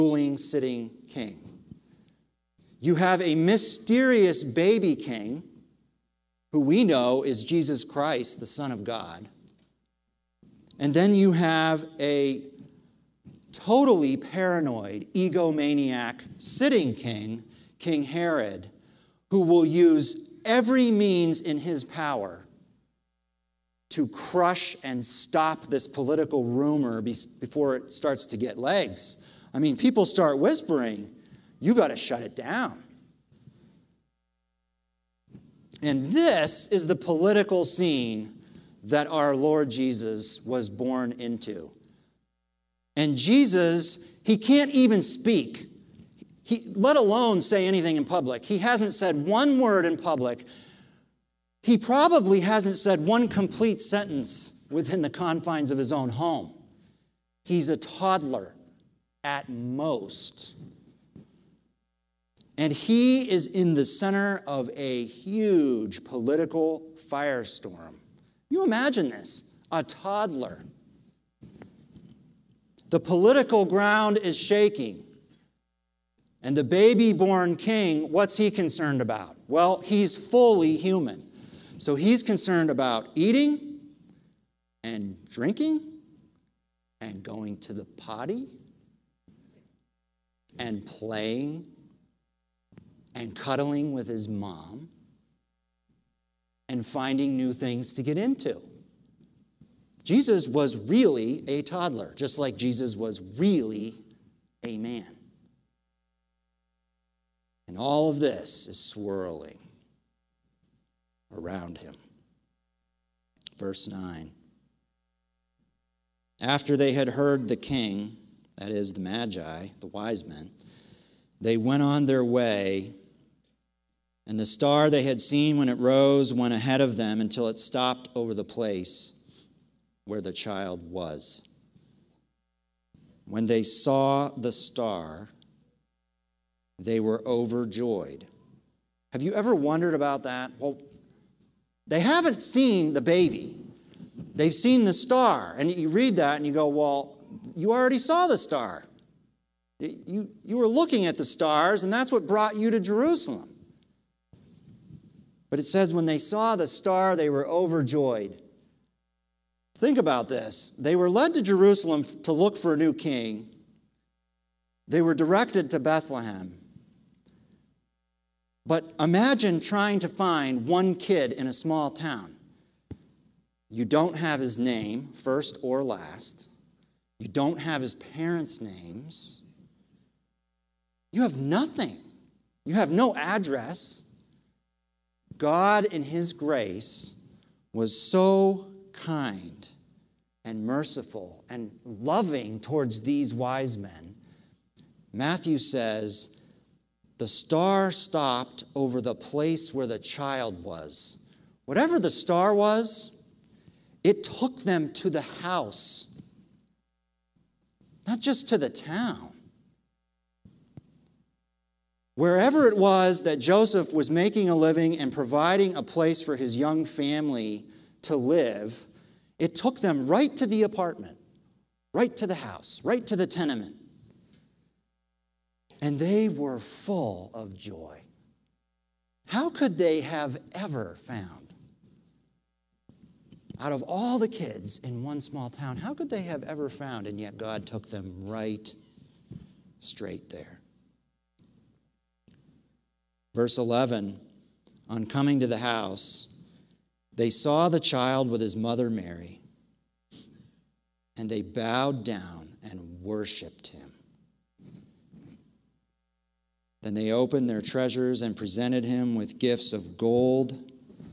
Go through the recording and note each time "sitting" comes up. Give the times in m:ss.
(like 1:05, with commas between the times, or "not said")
0:00, 0:16.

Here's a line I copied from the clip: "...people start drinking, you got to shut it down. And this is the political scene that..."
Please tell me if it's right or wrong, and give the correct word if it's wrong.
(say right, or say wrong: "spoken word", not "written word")
wrong: "whispering", not "drinking".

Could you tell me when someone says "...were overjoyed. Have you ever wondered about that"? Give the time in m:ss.
2:16.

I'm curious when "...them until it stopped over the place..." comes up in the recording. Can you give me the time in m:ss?
2:06.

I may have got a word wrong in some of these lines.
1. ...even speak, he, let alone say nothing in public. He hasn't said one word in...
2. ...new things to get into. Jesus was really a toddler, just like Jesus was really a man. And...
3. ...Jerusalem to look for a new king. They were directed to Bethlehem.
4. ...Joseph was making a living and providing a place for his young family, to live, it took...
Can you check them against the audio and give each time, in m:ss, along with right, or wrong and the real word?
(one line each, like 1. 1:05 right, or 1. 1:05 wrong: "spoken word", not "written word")
1. 0:44 wrong: "anything", not "nothing"
2. 1:37 right
3. 2:41 right
4. 3:33 right.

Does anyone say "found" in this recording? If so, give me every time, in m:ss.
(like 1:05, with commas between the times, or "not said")
3:51, 3:56.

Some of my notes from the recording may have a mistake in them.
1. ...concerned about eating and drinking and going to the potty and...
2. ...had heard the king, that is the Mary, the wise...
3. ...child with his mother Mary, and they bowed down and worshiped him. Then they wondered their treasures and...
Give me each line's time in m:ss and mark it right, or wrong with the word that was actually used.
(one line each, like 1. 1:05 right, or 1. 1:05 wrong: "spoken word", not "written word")
1. 1:22 right
2. 1:56 wrong: "Magi", not "Mary"
3. 4:07 wrong: "opened", not "wondered".